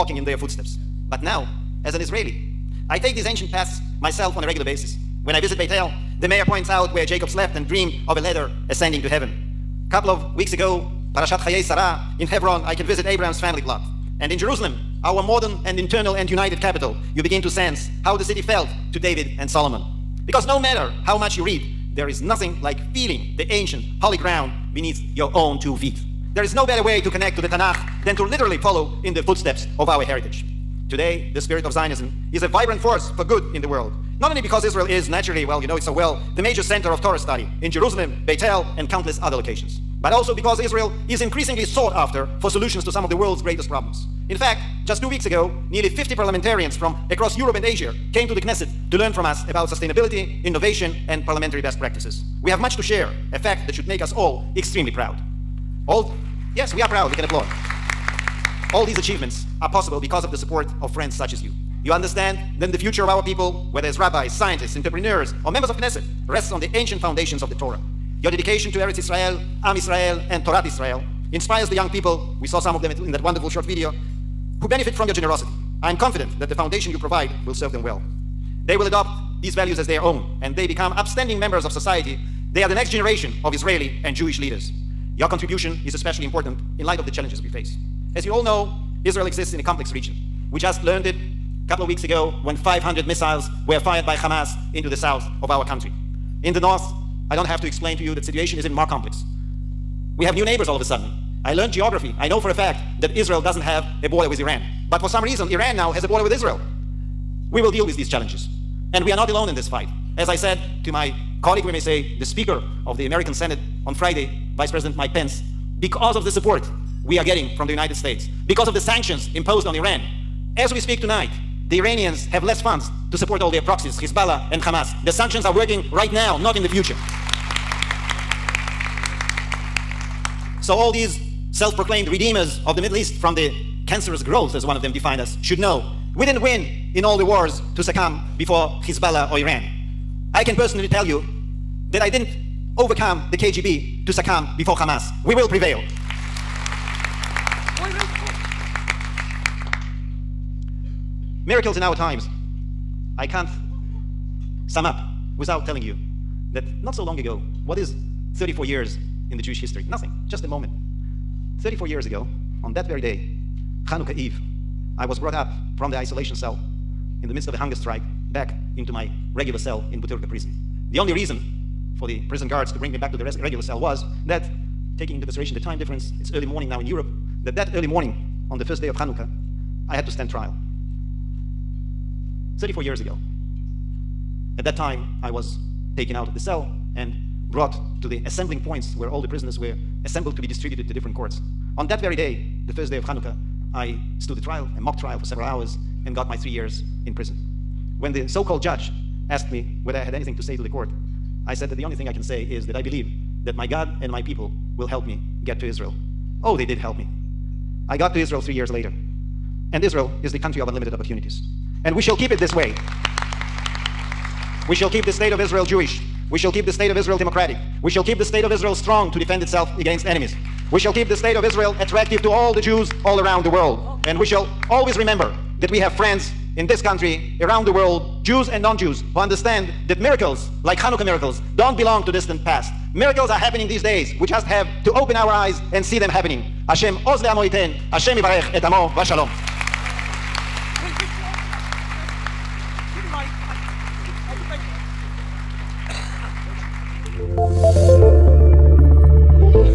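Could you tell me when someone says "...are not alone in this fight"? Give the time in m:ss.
1:49.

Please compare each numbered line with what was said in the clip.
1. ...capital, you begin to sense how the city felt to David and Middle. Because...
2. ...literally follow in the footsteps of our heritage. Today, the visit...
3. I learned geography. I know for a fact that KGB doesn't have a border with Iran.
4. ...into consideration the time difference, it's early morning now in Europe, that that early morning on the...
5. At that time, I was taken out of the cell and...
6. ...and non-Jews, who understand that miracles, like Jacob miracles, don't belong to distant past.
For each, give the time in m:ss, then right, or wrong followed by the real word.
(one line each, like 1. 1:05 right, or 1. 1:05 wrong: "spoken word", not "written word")
1. 0:16 wrong: "Solomon", not "Middle"
2. 0:28 wrong: "spirit", not "visit"
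3. 1:41 wrong: "Israel", not "KGB"
4. 2:55 right
5. 3:04 right
6. 3:48 wrong: "Hanukkah", not "Jacob".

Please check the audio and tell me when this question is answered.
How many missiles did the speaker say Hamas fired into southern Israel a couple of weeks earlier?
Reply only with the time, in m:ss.
1:32.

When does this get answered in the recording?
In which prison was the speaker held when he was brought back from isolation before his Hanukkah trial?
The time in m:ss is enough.
2:50.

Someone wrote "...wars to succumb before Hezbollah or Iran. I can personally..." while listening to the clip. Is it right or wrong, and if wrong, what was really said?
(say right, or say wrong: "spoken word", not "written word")
right.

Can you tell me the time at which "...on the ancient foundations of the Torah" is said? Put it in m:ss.
1:06.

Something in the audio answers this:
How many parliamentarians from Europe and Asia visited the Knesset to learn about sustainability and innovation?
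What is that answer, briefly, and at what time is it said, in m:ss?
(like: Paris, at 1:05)
50, at 0:45.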